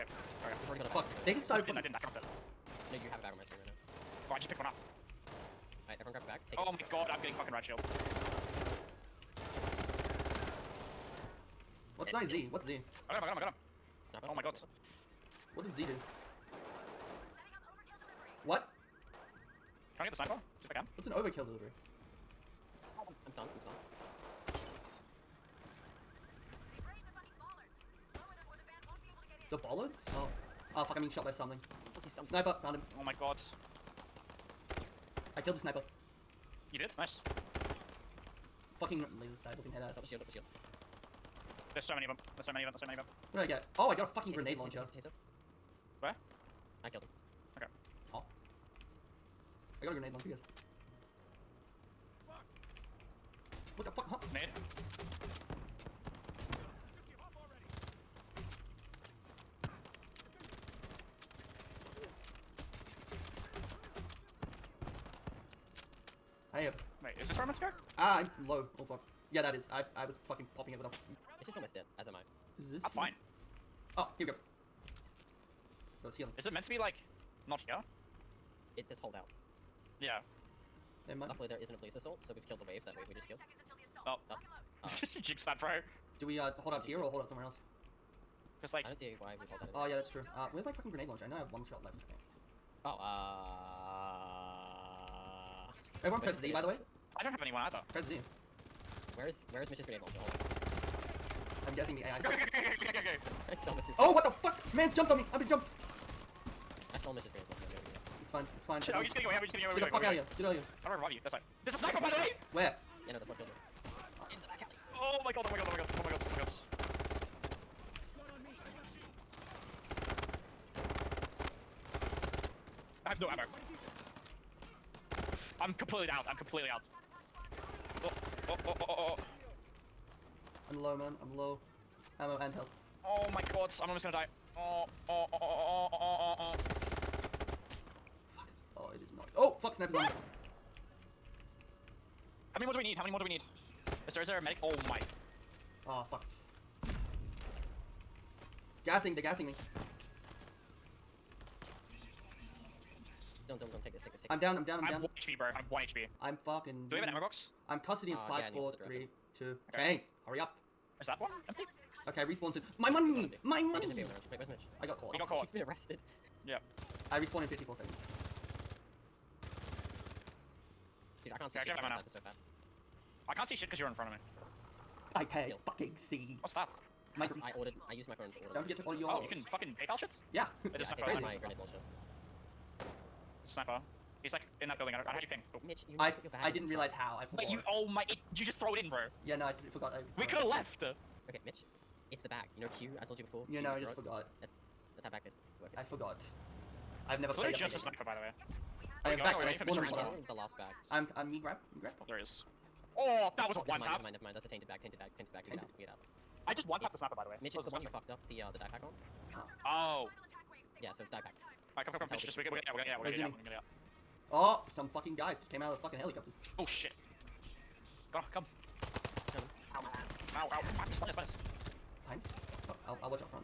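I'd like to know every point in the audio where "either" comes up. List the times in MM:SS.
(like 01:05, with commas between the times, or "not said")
01:37.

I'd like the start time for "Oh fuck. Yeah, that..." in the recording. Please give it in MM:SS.
01:08.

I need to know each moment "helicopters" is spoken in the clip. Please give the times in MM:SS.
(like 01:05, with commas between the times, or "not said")
03:35.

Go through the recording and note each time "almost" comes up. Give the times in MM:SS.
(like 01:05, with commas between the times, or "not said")
01:11, 02:13.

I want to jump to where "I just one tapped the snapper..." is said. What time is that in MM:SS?
03:26.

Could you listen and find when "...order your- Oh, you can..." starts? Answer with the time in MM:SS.
02:58.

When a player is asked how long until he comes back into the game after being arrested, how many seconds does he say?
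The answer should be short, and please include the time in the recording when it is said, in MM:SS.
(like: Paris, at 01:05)
54, at 02:47.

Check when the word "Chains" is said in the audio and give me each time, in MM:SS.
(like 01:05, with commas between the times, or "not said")
02:39.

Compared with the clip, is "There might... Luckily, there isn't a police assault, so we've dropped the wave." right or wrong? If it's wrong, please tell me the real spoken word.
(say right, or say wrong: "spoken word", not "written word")
wrong: "killed", not "dropped".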